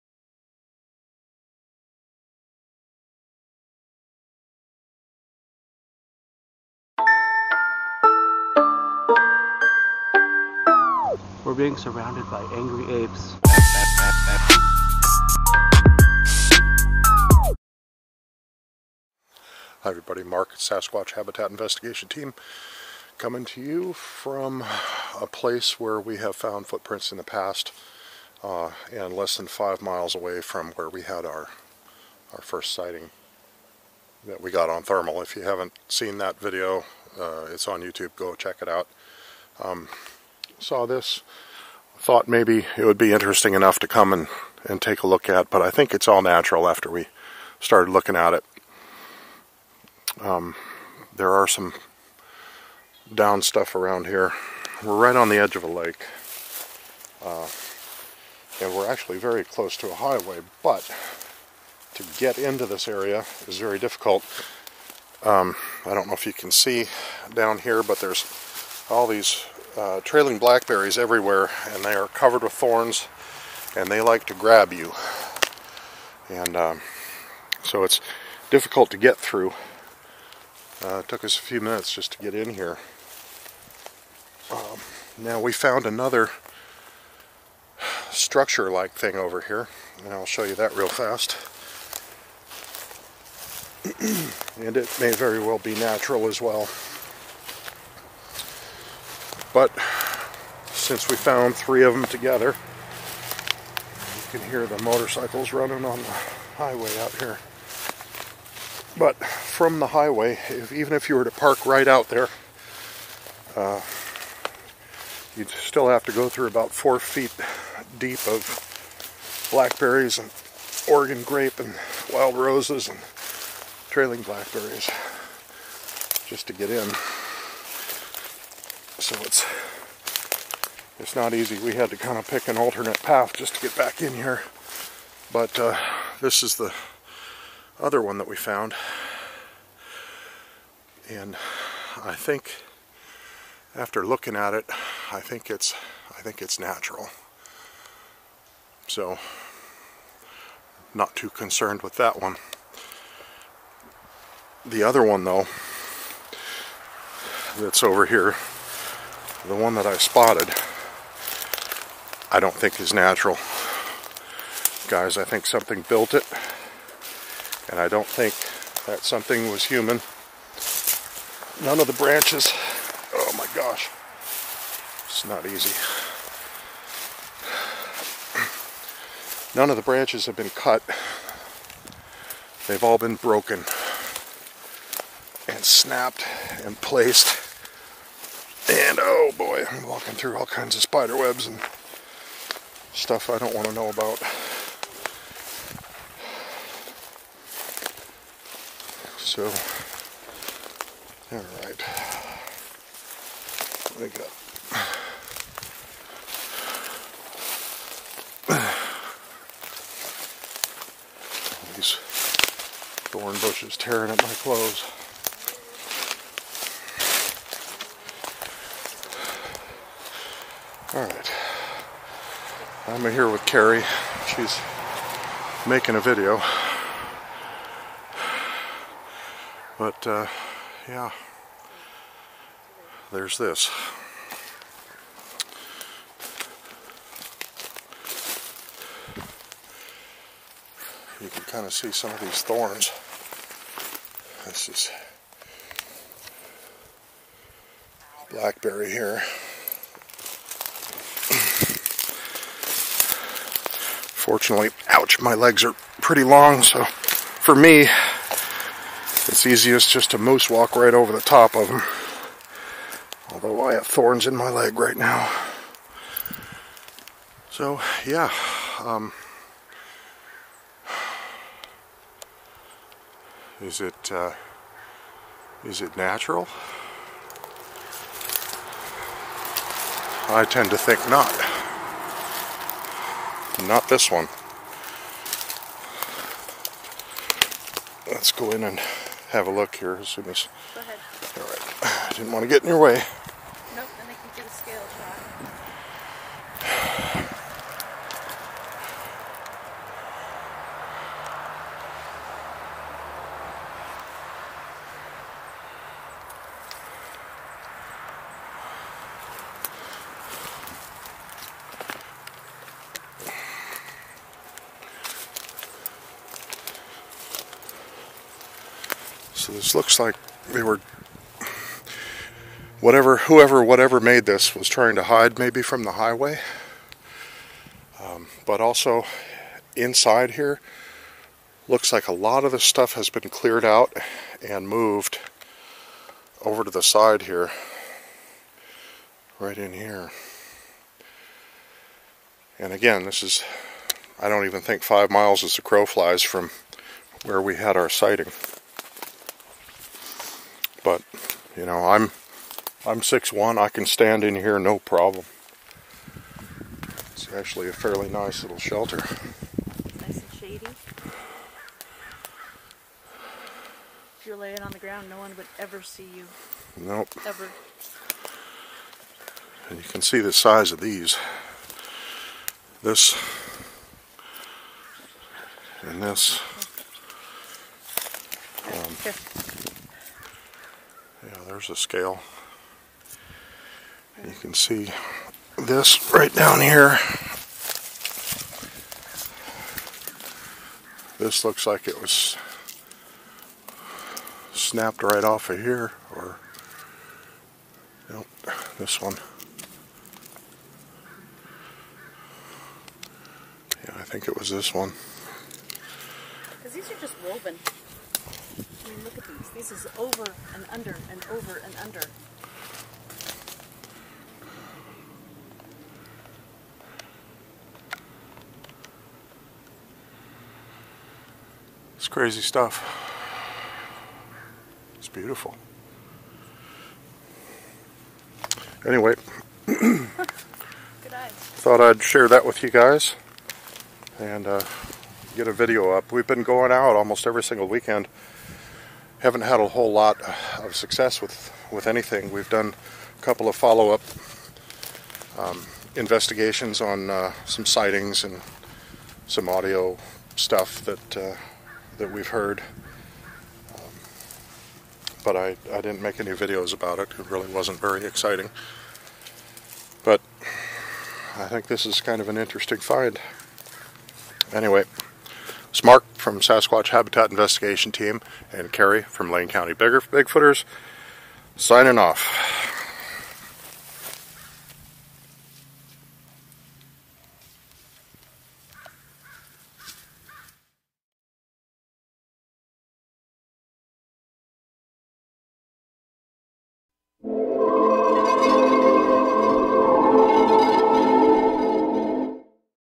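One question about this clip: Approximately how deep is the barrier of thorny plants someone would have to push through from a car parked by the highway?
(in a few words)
4 feet.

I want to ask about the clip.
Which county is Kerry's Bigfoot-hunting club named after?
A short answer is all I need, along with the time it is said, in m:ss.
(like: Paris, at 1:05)
Lane County, at 7:49.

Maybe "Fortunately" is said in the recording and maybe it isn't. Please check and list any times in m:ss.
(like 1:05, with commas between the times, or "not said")
4:14.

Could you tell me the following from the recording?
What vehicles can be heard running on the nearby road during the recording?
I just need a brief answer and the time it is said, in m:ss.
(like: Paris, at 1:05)
motorcycles, at 1:44.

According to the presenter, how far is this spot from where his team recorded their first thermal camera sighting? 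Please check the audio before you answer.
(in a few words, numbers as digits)
less than 5 miles.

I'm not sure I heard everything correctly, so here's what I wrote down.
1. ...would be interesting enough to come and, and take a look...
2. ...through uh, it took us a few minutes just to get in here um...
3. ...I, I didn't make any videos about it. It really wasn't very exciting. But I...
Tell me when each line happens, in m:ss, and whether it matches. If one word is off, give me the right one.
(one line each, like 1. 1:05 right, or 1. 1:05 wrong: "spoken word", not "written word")
1. 0:42 right
2. 1:19 right
3. 7:35 right.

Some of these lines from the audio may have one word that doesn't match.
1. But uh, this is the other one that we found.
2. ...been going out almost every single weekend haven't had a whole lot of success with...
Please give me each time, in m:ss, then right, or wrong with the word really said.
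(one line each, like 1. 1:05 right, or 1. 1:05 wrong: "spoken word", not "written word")
1. 2:15 right
2. 7:16 right.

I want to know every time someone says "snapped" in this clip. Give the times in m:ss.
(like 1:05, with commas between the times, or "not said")
3:05, 6:34.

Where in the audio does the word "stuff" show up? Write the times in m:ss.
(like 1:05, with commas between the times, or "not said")
0:53, 3:12, 5:32, 7:02, 7:30.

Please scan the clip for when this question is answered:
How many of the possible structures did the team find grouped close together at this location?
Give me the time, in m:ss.
1:41.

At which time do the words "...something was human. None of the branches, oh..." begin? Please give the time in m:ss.
2:49.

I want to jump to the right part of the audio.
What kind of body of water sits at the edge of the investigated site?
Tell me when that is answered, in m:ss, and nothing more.
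0:55.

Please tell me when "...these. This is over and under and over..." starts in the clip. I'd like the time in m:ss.
6:49.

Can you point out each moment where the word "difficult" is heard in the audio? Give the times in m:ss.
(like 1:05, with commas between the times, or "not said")
1:03, 1:18.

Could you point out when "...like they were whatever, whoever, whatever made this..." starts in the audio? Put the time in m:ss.
5:19.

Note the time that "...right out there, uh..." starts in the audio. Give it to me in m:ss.
1:51.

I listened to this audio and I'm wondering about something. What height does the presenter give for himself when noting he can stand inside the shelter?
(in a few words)
6'1".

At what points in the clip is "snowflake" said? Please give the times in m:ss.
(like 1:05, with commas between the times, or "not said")
not said.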